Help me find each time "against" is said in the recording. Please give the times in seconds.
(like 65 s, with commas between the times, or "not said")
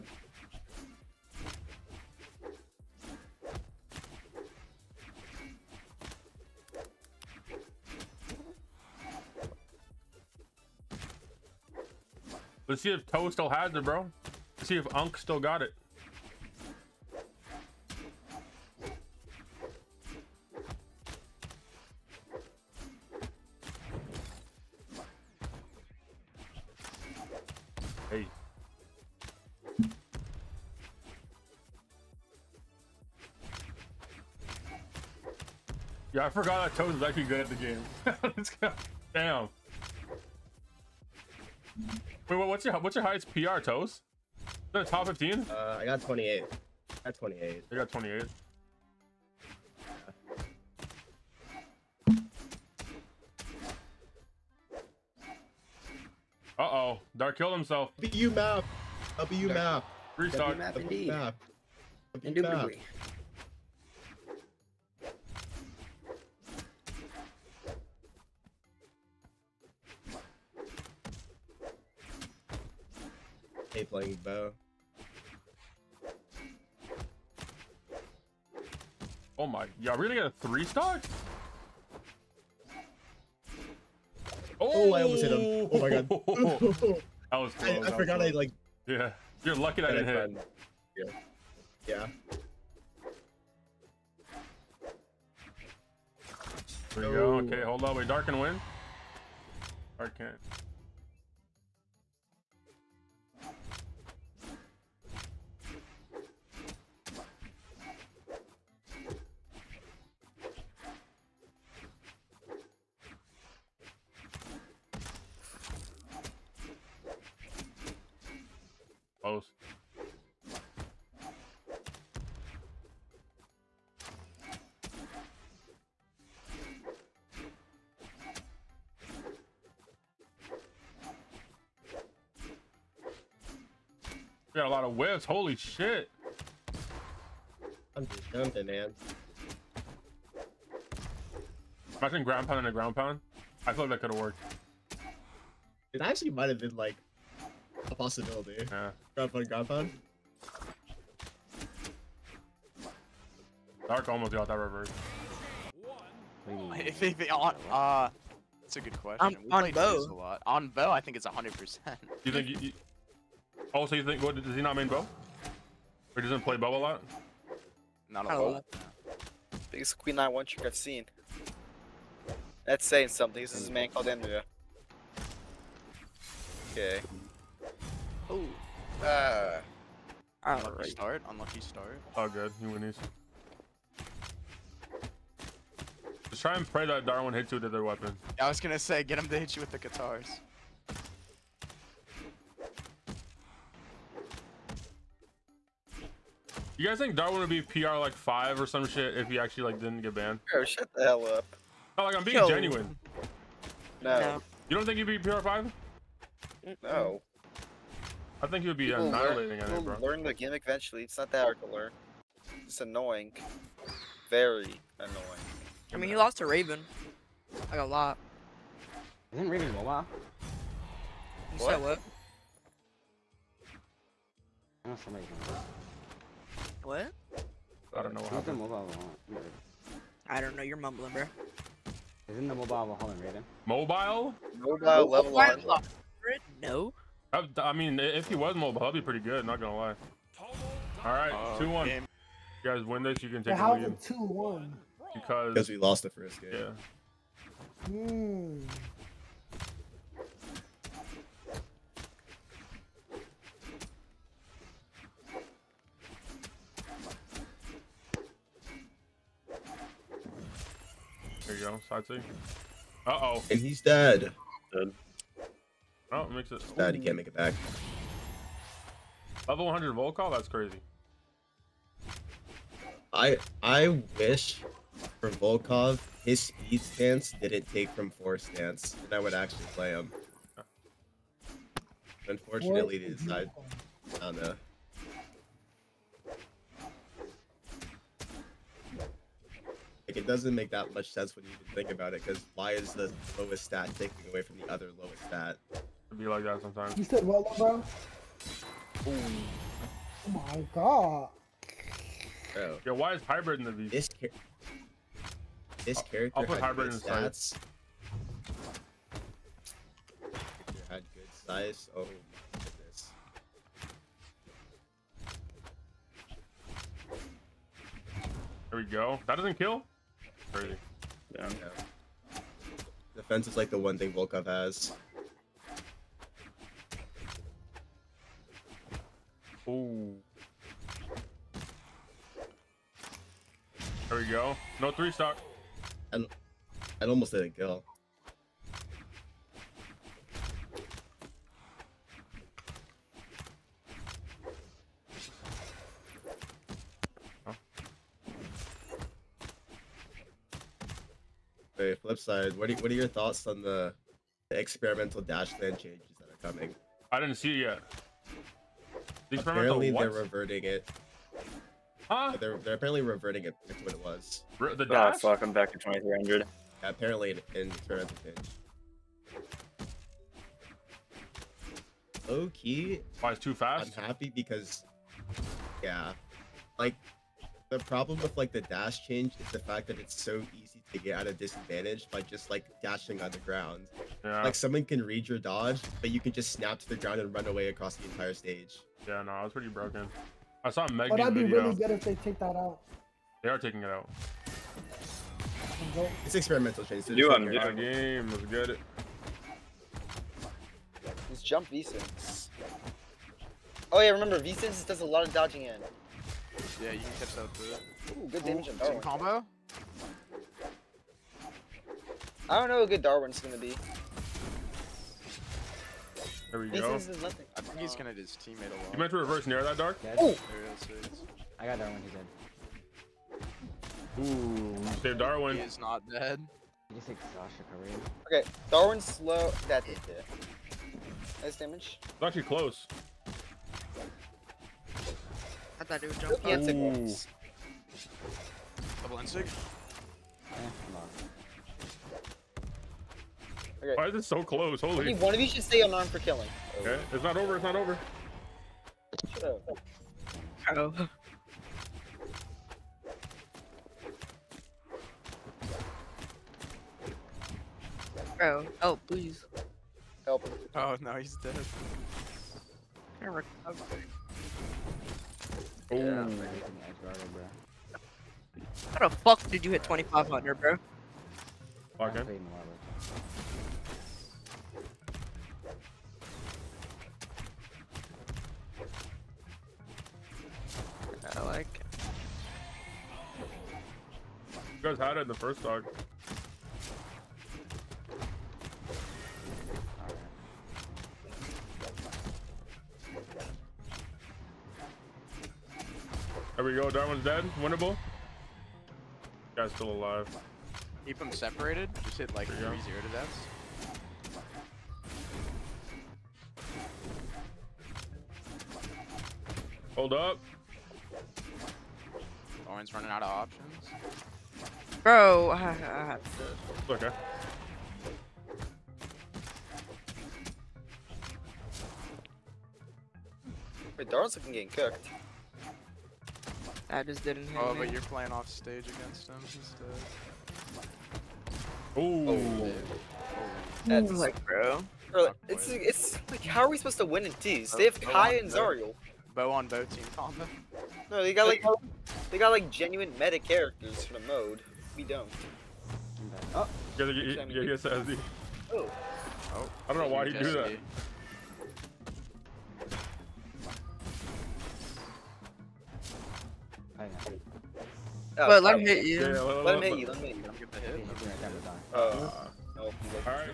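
528 s.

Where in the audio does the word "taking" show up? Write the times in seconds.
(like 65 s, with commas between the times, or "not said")
293 s, 393 s.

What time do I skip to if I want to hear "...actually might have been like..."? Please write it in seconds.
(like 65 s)
146 s.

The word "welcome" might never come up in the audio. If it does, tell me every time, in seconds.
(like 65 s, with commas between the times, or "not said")
365 s.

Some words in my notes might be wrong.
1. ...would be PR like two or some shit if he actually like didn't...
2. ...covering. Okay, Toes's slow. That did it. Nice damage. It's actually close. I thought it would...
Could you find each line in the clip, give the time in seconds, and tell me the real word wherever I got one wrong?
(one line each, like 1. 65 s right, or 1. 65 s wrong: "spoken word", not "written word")
1. 197 s wrong: "five", not "two"
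2. 427 s wrong: "Darwin", not "Toes".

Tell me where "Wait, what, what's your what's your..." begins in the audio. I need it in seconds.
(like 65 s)
42 s.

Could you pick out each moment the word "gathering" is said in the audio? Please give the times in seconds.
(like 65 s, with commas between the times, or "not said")
not said.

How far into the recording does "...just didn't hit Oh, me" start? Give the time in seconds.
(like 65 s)
527 s.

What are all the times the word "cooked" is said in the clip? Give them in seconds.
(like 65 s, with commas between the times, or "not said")
524 s.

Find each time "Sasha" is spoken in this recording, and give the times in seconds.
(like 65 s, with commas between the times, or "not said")
427 s.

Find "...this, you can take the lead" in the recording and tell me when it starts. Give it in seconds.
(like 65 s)
243 s.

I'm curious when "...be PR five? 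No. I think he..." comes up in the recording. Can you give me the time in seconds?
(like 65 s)
205 s.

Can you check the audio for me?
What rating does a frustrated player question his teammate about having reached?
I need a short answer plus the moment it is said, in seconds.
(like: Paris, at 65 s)
2500, at 468 s.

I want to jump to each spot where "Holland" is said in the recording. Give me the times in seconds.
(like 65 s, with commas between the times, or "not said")
233 s.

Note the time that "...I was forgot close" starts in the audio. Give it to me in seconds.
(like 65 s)
87 s.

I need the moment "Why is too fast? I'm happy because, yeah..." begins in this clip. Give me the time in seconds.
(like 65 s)
373 s.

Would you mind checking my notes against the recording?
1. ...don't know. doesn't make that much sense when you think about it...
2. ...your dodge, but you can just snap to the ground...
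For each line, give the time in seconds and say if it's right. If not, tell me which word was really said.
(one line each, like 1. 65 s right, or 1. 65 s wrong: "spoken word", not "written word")
1. 284 s right
2. 385 s right.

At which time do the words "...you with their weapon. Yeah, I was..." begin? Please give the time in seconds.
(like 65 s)
187 s.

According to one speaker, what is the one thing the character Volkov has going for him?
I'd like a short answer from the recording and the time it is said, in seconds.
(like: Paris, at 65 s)
Defense, at 323 s.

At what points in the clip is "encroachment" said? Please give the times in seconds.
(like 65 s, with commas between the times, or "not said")
not said.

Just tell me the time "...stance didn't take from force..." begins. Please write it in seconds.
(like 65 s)
276 s.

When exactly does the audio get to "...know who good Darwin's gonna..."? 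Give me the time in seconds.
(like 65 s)
412 s.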